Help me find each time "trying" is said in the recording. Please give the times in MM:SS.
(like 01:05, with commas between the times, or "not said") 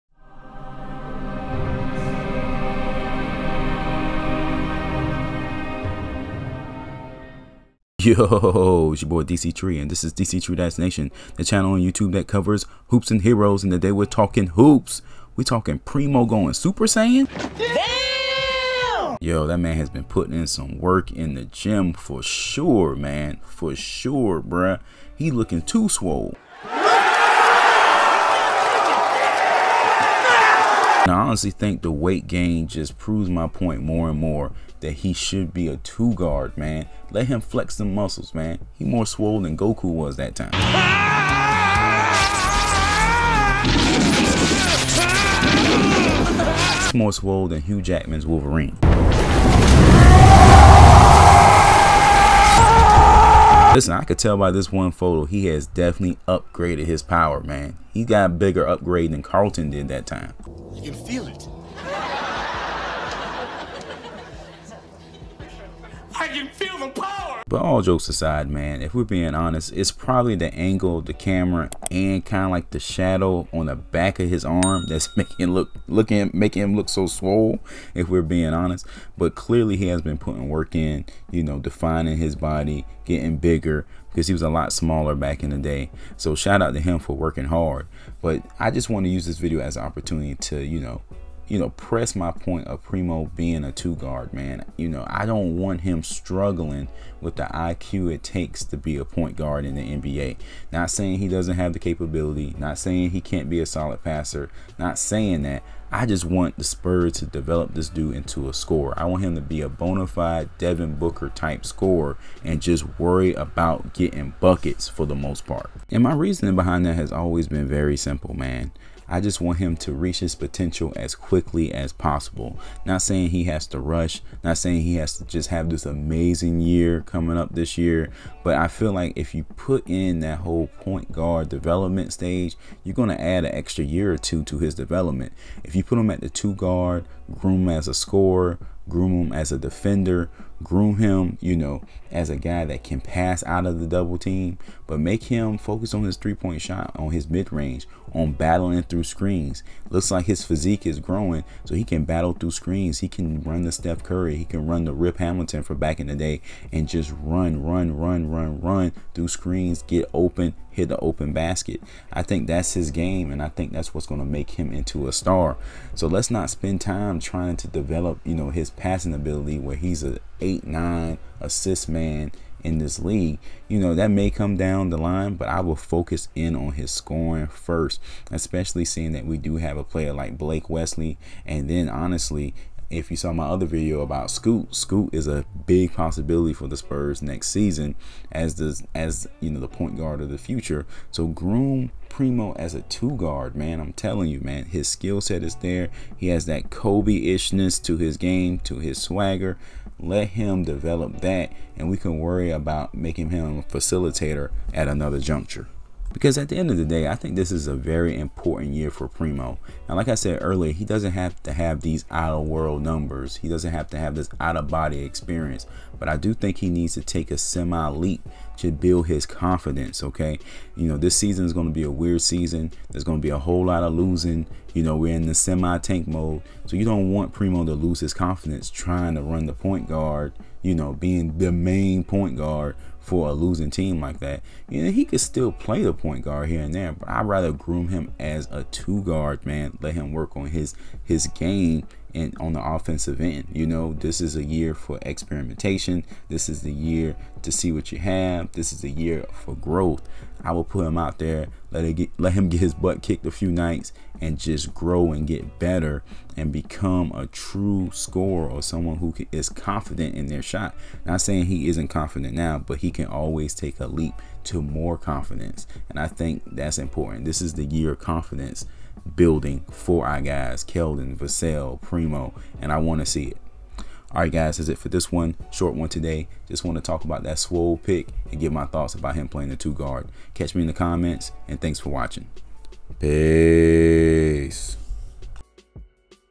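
02:47, 03:48.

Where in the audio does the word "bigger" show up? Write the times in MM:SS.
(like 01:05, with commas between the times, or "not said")
00:58, 01:23.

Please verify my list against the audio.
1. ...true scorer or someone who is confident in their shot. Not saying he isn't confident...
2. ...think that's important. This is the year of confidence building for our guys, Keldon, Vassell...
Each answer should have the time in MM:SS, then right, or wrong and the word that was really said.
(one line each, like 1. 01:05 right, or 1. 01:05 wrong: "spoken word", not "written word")
1. 04:17 right
2. 04:26 right.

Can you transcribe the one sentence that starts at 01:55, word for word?
And my reasoning behind that has always been very simple, man.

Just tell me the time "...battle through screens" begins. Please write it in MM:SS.
02:32.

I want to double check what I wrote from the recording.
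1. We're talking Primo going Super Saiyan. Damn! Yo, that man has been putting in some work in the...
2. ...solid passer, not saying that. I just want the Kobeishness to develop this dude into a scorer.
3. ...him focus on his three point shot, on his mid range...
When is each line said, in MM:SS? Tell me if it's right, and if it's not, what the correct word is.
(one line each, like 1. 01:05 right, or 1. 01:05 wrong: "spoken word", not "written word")
1. 00:15 right
2. 01:43 wrong: "Spurs", not "Kobeishness"
3. 02:25 right.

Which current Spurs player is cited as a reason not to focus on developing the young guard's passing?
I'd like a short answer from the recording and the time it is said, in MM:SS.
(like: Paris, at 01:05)
Blake Wesley, at 03:00.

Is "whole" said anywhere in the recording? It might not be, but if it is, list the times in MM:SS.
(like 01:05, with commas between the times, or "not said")
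02:10, 03:43.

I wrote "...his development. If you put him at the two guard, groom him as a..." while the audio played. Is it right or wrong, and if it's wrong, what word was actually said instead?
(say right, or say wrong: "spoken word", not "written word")
right.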